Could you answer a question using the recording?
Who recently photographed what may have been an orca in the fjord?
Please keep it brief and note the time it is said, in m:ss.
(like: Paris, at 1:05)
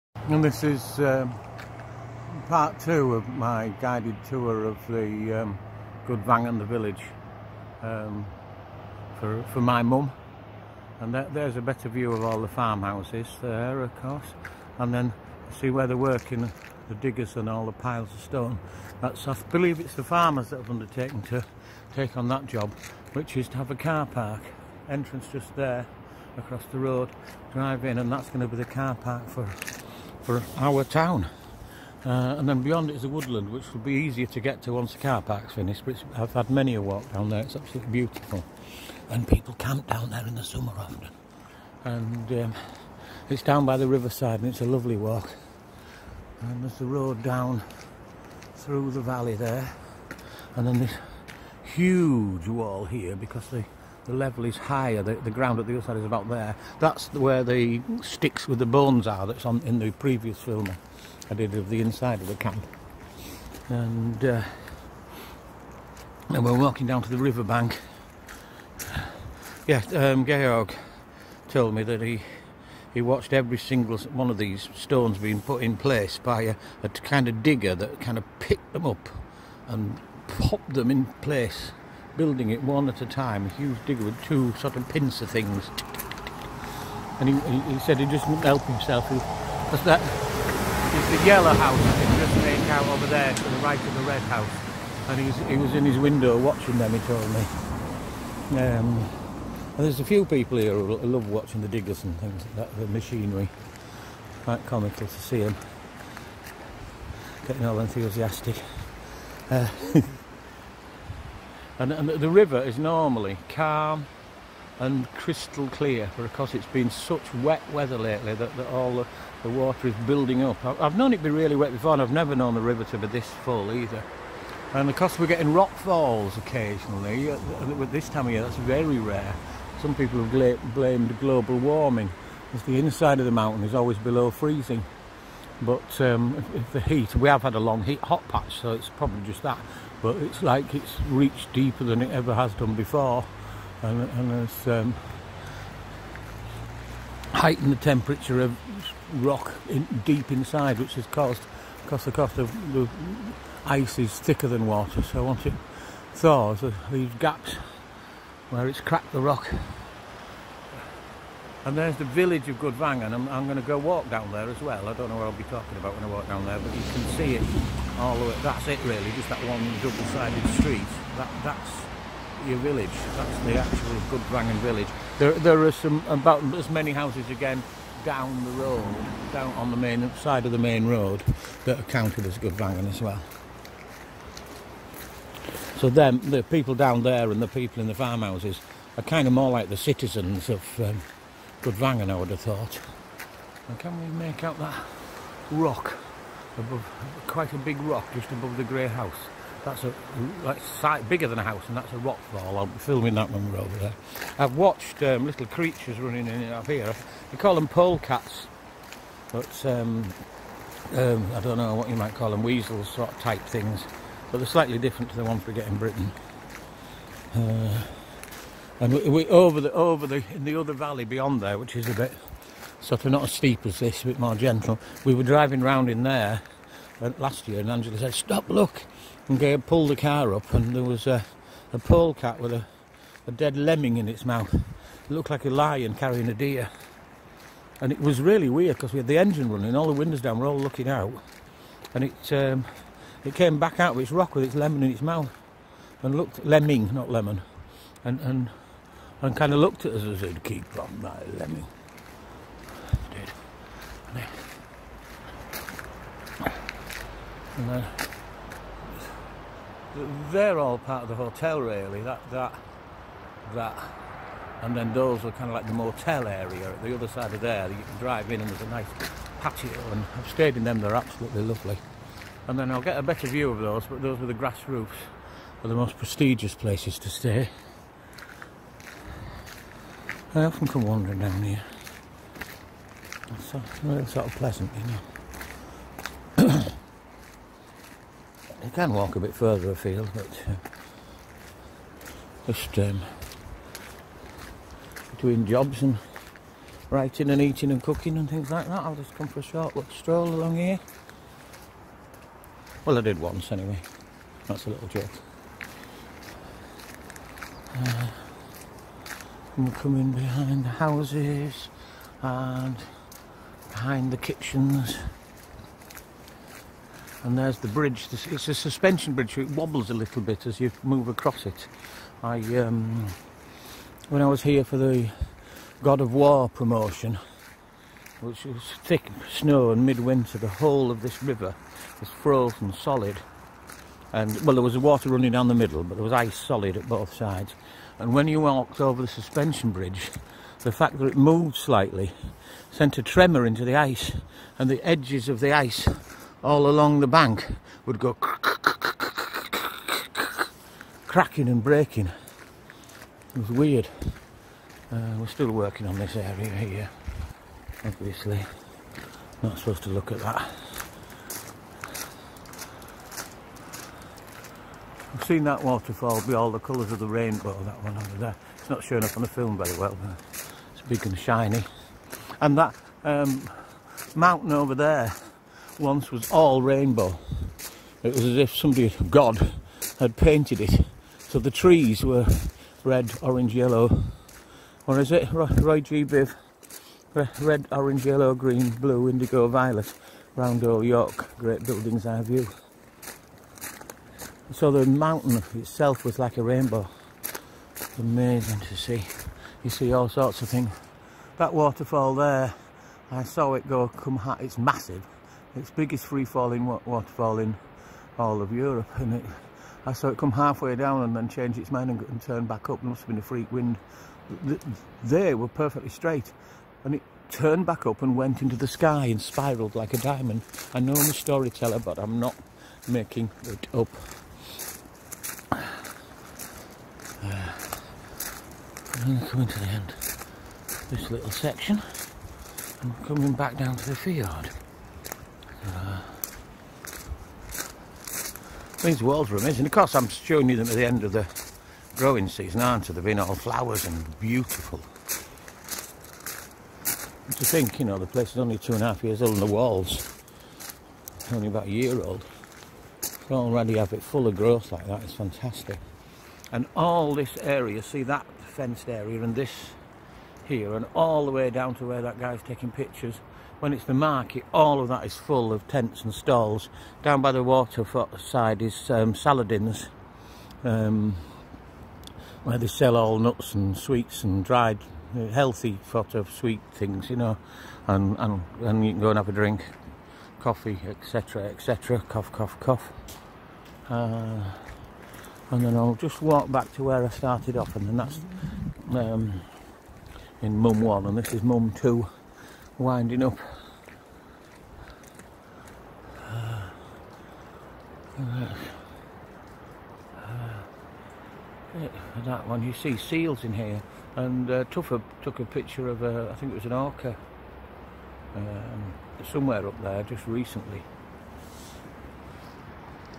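Tuffer, at 8:24.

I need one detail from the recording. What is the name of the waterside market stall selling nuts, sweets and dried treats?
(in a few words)
Saladin's.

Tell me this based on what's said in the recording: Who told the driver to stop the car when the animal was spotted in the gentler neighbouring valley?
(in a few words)
Angela.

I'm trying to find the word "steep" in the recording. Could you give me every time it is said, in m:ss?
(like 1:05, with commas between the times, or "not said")
3:43.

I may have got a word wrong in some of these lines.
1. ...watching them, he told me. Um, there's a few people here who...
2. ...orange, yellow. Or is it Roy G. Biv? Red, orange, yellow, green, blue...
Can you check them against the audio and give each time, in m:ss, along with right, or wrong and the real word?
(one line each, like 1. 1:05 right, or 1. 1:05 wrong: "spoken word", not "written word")
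1. 1:36 right
2. 6:23 right.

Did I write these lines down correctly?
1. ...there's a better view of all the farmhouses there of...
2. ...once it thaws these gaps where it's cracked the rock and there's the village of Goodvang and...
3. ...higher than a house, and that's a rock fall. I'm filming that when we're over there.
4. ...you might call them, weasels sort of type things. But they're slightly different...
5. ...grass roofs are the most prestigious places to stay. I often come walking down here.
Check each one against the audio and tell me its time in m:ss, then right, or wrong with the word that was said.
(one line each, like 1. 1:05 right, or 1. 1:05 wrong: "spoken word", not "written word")
1. 0:11 right
2. 2:35 right
3. 3:21 wrong: "bigger", not "higher"
4. 3:31 right
5. 4:34 wrong: "wandering", not "walking".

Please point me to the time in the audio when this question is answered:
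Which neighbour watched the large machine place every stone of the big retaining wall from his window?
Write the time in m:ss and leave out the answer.
1:10.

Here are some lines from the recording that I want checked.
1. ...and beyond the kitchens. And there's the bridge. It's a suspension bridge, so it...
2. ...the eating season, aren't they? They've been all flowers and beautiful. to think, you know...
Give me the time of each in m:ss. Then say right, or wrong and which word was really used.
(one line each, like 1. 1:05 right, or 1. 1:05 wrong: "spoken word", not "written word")
1. 5:12 wrong: "behind", not "beyond"
2. 7:21 wrong: "growing", not "eating".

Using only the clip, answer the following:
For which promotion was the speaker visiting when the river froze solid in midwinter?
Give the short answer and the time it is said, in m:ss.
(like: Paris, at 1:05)
God of War, at 5:25.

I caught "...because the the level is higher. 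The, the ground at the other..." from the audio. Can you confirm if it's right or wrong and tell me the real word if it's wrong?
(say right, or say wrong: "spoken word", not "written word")
right.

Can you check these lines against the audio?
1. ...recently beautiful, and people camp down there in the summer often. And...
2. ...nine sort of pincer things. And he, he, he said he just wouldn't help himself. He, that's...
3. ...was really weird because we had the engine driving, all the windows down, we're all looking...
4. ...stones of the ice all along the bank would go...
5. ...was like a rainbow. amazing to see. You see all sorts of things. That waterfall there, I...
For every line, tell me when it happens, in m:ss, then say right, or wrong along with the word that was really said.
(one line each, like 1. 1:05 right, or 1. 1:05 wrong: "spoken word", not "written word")
1. 0:37 wrong: "absolutely", not "recently"
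2. 1:24 wrong: "two", not "nine"
3. 3:58 wrong: "running", not "driving"
4. 5:44 wrong: "edges", not "stones"
5. 6:36 right.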